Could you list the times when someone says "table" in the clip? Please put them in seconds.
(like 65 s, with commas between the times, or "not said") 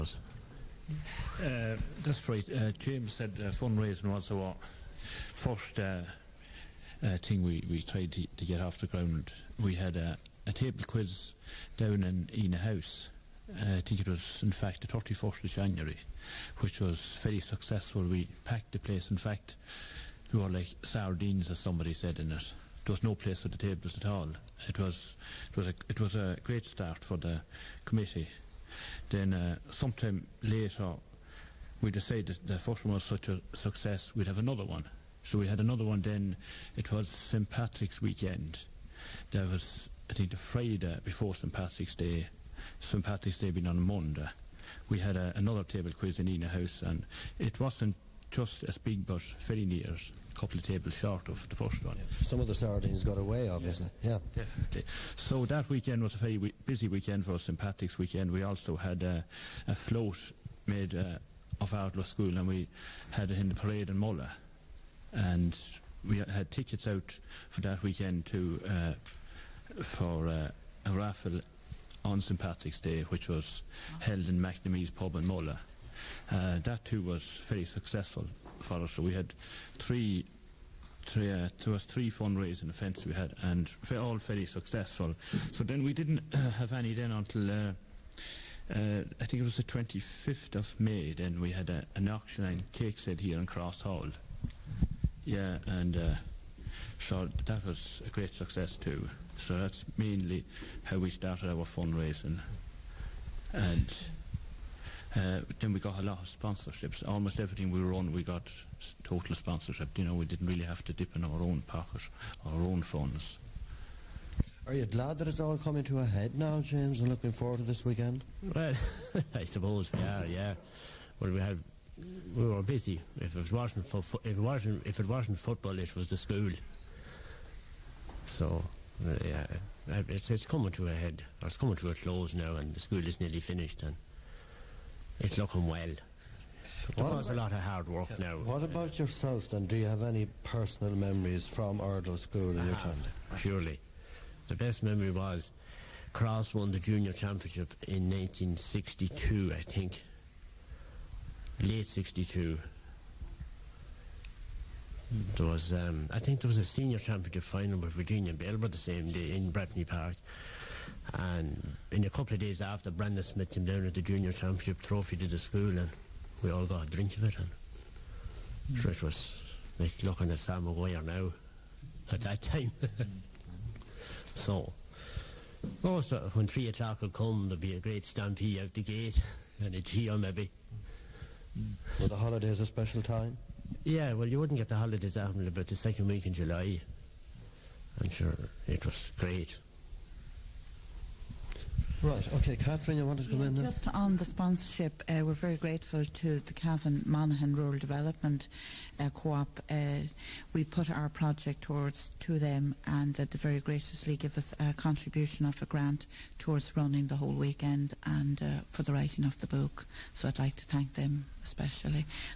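10 s, 23 s, 45 s, 50 s.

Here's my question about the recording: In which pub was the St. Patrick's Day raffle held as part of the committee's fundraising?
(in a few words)
McNamee's.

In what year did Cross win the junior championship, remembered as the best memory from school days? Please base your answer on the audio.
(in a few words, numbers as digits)
1962.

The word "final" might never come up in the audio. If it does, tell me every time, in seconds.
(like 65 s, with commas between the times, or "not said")
157 s.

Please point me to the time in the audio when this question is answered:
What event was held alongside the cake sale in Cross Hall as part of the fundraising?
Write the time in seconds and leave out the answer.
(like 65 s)
92 s.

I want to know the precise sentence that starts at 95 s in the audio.
Yeah, and uh, so that was a great success too.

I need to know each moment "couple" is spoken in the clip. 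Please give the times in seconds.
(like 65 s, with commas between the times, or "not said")
50 s, 162 s.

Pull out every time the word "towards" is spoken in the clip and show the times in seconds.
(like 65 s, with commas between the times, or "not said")
201 s, 206 s.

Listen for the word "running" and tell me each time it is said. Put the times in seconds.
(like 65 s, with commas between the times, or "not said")
206 s.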